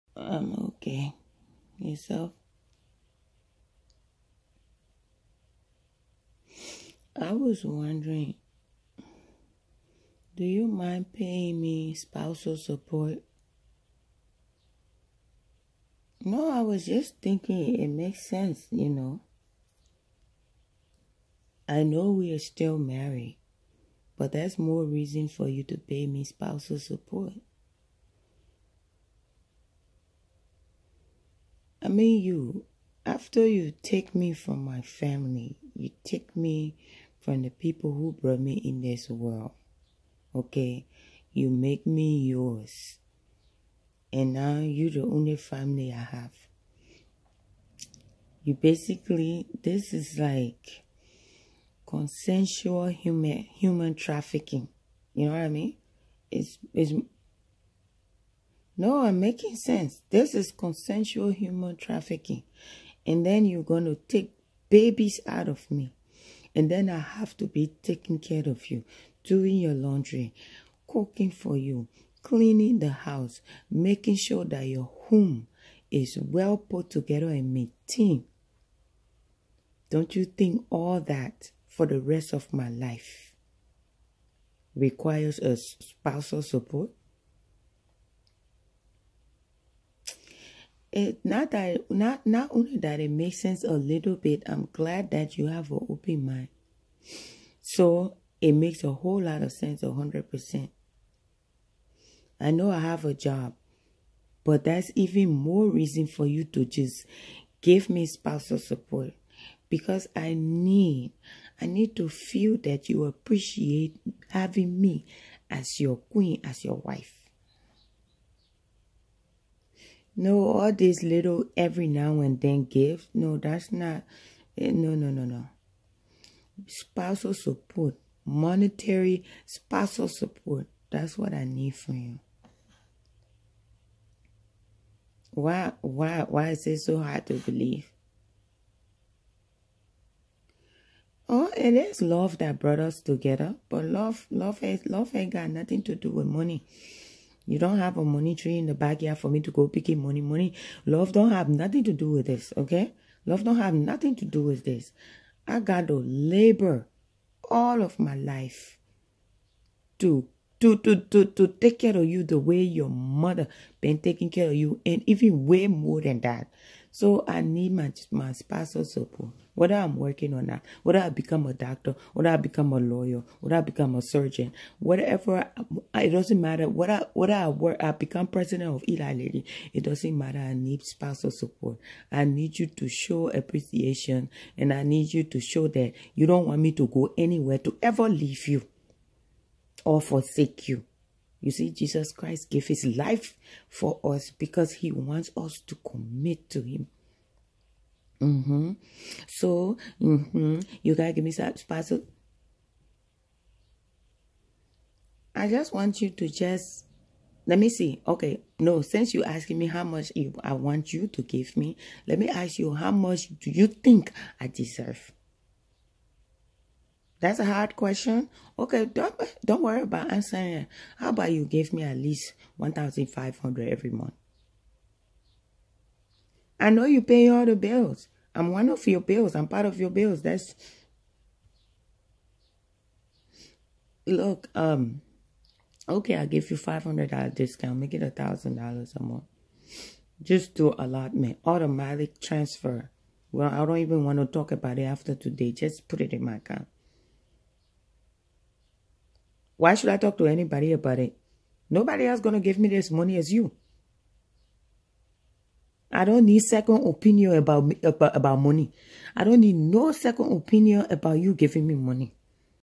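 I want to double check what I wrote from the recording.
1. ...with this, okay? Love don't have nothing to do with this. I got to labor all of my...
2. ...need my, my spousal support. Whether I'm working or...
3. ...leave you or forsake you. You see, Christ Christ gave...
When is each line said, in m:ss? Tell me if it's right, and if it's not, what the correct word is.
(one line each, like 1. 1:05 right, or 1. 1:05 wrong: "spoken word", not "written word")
1. 2:32 right
2. 2:47 right
3. 3:08 wrong: "Jesus", not "Christ".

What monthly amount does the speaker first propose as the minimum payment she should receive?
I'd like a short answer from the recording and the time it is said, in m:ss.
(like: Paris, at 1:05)
$1500, at 3:42.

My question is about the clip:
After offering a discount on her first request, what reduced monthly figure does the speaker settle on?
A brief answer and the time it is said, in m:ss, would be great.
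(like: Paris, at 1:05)
$1000, at 3:58.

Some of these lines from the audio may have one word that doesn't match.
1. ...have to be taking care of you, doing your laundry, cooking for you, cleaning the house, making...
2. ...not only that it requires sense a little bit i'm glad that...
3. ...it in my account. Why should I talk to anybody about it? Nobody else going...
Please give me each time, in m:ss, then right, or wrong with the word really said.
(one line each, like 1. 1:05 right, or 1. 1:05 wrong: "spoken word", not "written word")
1. 1:06 right
2. 1:32 wrong: "makes", not "requires"
3. 4:05 right.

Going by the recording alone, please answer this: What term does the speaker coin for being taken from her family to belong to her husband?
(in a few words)
consensual human trafficking.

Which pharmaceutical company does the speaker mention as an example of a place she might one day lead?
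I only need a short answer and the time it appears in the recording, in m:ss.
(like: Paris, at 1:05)
Eli Lilly, at 2:58.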